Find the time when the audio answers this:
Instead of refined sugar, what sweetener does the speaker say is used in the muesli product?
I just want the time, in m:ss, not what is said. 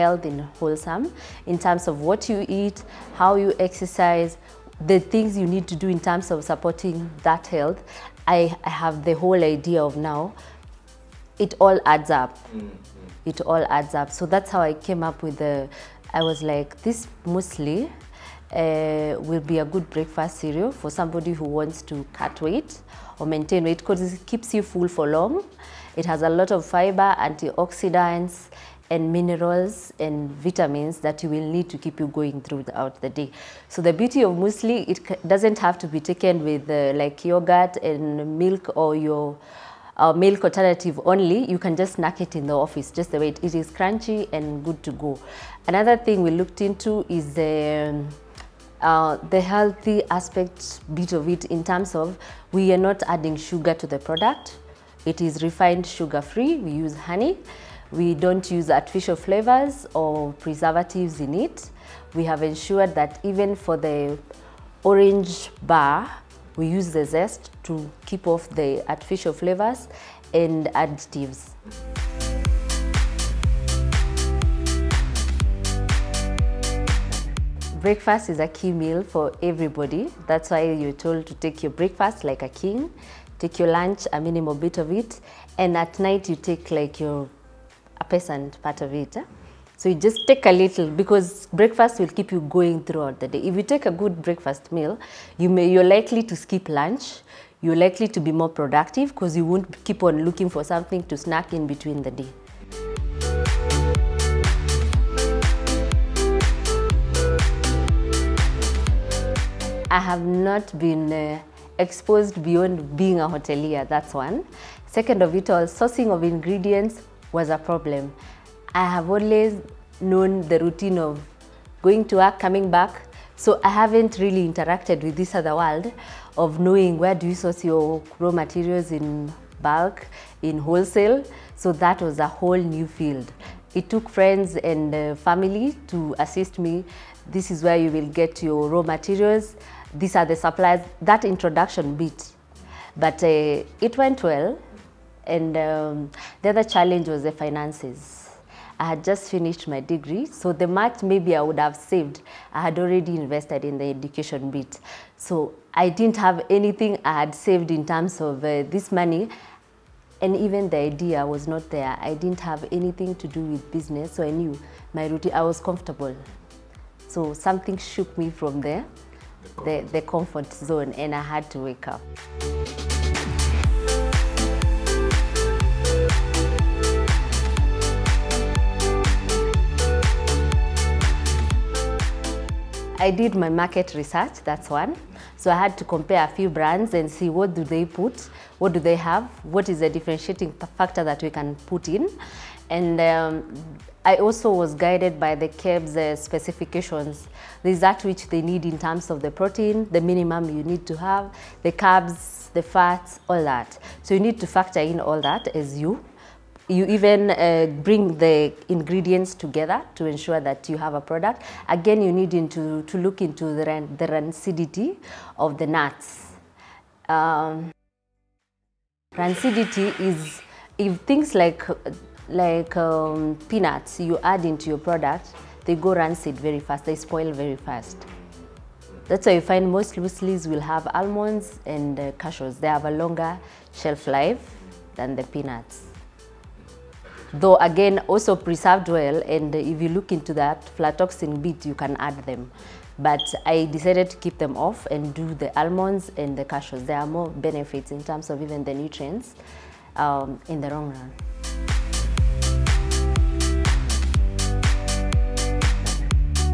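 0:56.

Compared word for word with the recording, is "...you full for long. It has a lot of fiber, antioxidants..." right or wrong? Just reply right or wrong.
right.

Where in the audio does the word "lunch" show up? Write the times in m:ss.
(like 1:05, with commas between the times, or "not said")
1:23, 1:36.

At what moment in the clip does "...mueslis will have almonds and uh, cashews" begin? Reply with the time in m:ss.
3:49.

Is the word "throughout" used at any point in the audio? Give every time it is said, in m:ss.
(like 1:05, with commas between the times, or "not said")
0:32, 1:32.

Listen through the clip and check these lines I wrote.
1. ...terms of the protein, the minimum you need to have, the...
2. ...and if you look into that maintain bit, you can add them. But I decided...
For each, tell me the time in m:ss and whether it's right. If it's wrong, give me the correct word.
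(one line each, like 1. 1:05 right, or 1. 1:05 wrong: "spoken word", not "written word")
1. 3:18 right
2. 3:59 wrong: "aflatoxin", not "maintain".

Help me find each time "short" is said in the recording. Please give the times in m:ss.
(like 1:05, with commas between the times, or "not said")
not said.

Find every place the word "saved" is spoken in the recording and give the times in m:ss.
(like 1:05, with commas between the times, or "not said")
2:31, 2:37.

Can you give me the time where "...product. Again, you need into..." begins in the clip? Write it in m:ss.
3:31.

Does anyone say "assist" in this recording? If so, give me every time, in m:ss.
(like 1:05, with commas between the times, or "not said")
2:16.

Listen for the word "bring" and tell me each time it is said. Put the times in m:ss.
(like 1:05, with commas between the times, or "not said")
3:27.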